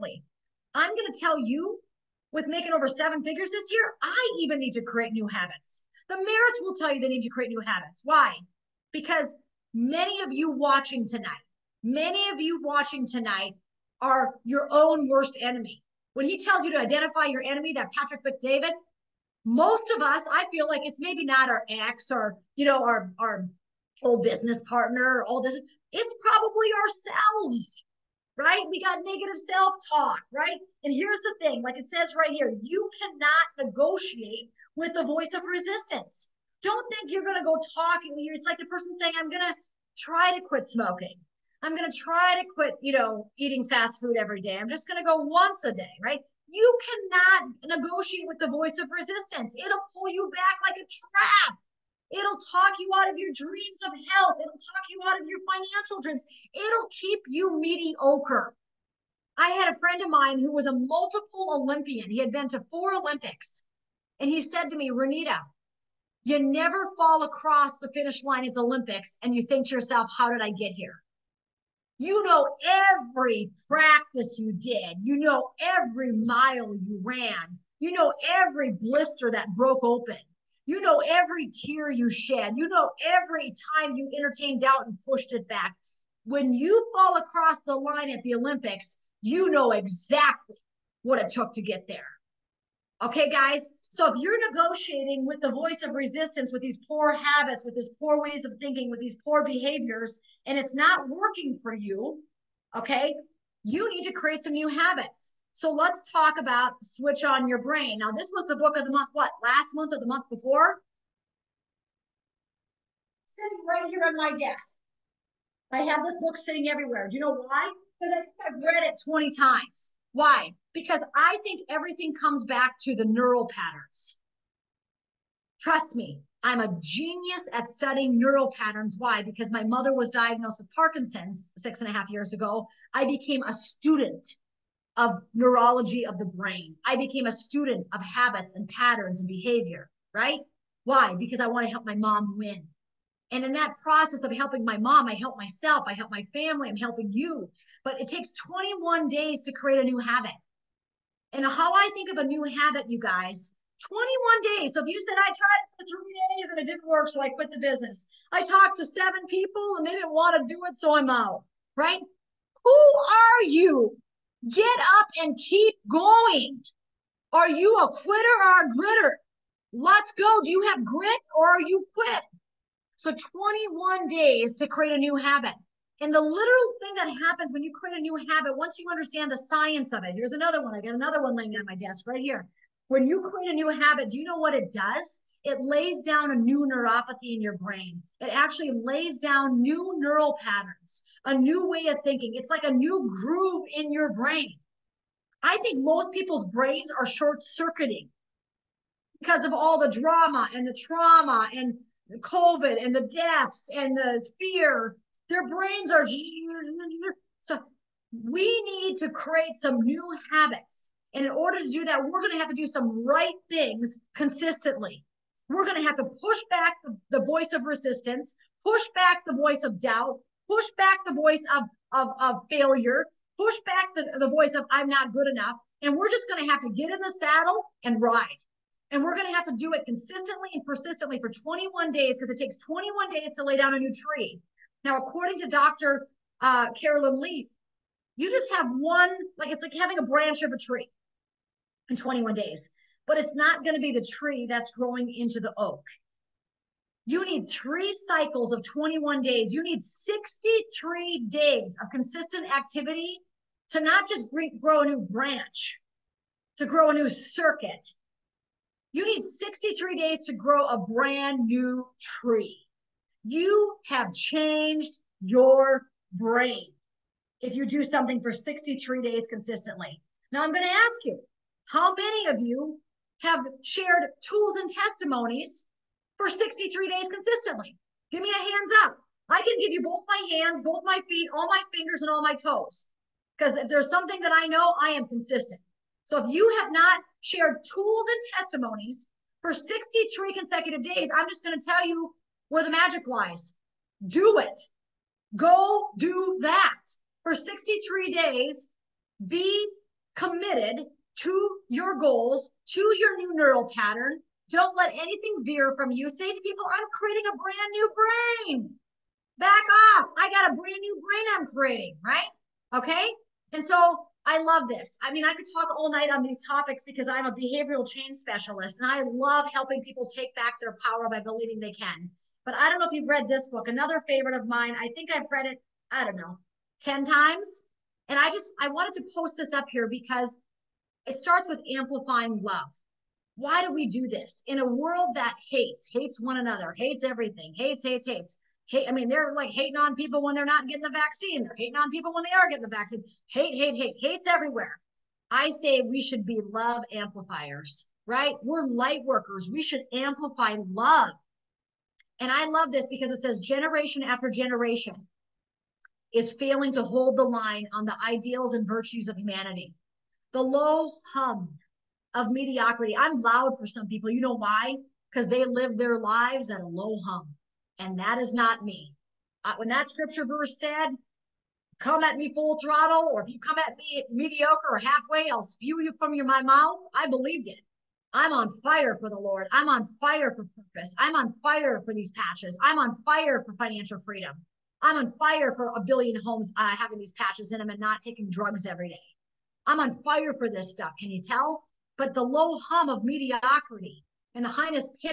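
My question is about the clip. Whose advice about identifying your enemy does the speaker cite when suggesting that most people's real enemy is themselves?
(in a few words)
Patrick Bet-David.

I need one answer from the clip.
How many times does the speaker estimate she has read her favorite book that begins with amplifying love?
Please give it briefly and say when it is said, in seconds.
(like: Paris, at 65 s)
10, at 326 s.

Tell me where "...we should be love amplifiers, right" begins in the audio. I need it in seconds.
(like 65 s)
345 s.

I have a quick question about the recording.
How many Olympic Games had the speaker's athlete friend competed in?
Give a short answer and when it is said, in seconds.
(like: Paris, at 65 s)
4, at 62 s.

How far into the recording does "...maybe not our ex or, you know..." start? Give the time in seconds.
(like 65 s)
20 s.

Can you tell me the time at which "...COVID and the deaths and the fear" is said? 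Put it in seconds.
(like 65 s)
202 s.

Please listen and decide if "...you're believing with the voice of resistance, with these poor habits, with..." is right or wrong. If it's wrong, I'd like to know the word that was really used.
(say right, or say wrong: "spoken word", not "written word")
wrong: "negotiating", not "believing".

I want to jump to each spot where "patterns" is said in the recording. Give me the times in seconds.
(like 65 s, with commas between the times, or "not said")
123 s, 128 s, 138 s, 190 s, 303 s.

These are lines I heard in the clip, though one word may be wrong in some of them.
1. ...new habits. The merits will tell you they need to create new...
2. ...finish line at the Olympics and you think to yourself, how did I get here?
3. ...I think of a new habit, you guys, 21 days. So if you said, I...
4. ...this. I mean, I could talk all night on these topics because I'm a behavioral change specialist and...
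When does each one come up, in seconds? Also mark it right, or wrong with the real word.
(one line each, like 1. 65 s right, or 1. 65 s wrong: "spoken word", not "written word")
1. 5 s right
2. 67 s right
3. 151 s right
4. 314 s right.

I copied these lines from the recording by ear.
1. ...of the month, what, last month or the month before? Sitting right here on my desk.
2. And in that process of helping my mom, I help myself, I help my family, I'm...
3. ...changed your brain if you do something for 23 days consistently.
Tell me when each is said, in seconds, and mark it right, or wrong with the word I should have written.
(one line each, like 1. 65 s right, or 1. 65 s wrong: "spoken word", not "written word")
1. 108 s right
2. 143 s right
3. 264 s wrong: "63", not "23".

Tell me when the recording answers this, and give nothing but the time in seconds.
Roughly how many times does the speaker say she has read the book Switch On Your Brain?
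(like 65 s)
119 s.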